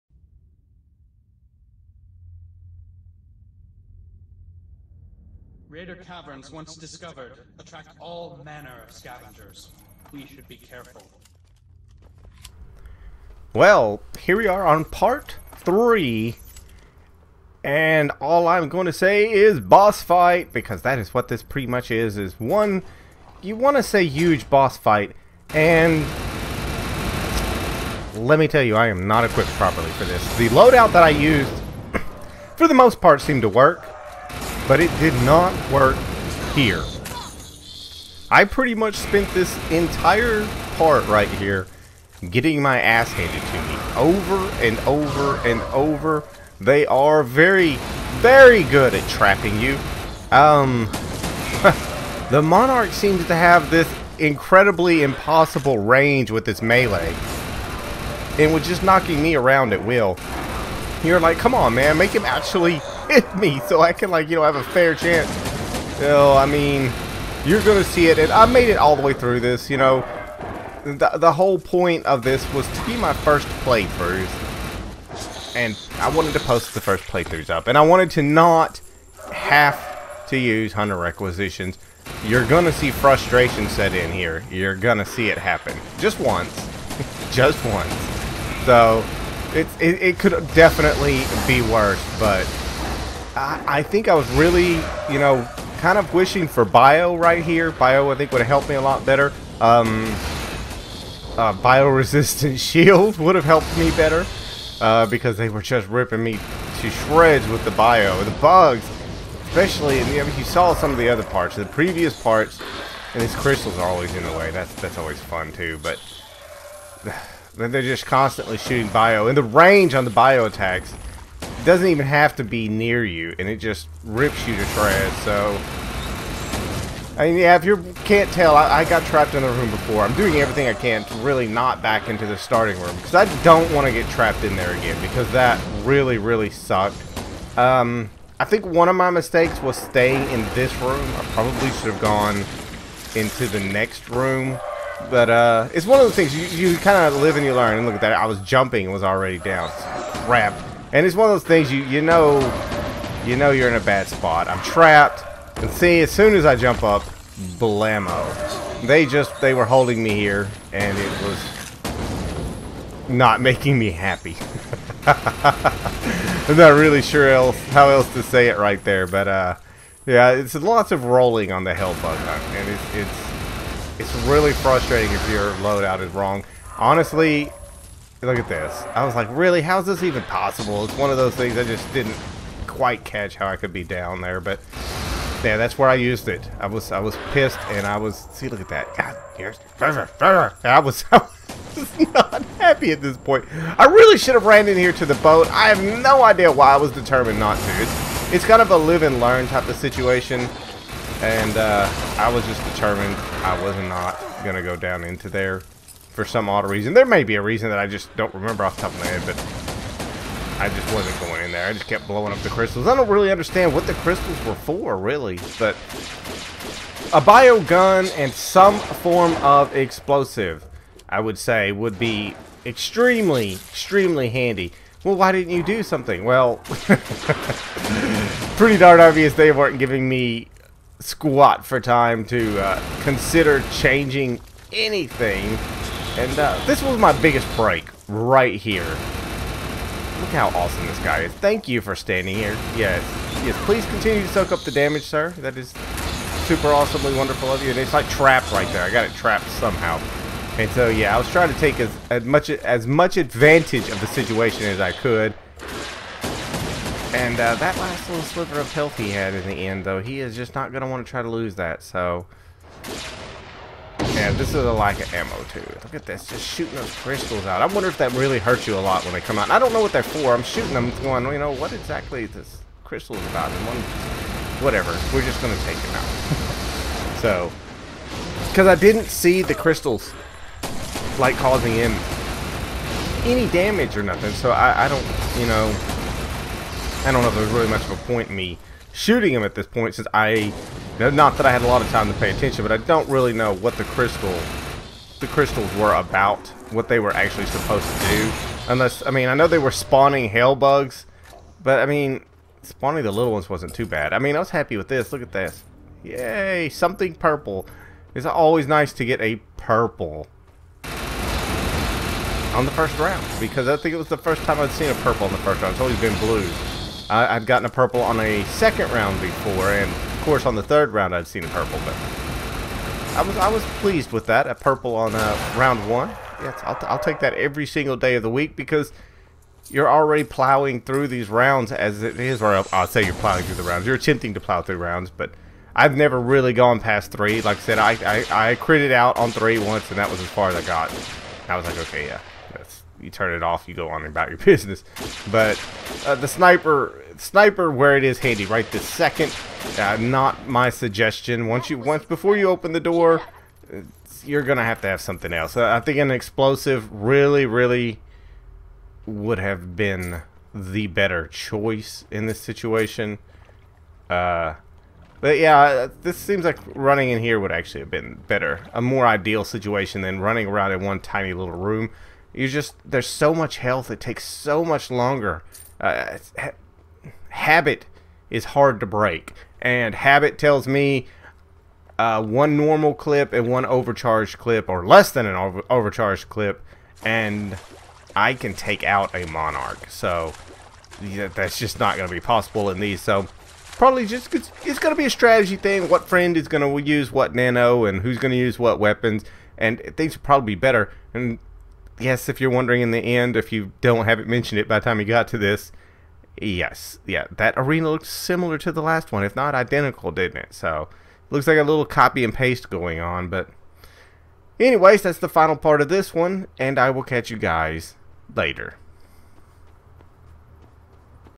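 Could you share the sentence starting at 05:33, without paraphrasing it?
You're attempting to plow through rounds, but I've never really gone past three.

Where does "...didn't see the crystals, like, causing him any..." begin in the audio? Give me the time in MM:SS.
04:38.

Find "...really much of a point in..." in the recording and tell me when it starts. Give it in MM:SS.
04:47.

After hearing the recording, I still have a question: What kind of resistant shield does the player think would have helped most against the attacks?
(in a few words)
Bio-resistant.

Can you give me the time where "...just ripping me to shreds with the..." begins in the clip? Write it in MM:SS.
01:45.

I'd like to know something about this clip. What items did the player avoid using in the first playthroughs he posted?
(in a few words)
Hunter requisitions.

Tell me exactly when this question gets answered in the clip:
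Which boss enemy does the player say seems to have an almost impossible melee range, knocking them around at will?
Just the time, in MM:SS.
00:52.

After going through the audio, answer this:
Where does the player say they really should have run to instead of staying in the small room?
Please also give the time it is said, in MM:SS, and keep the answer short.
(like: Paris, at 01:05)
The boat, at 03:15.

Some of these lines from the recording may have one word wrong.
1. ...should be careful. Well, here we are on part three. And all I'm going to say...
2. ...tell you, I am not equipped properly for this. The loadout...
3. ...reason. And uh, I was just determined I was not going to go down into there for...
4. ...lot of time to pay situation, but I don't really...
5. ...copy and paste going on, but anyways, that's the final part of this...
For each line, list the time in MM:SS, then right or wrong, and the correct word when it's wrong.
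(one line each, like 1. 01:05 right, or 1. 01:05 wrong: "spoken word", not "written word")
1. 00:10 right
2. 00:28 right
3. 03:19 wrong: "situation", not "reason"
4. 04:51 wrong: "attention", not "situation"
5. 06:51 right.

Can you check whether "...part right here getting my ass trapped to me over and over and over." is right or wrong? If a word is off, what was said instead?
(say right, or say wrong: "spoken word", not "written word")
wrong: "handed", not "trapped".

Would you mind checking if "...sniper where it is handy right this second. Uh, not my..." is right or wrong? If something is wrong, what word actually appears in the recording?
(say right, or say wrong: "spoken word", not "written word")
right.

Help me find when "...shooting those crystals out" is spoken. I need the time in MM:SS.
04:26.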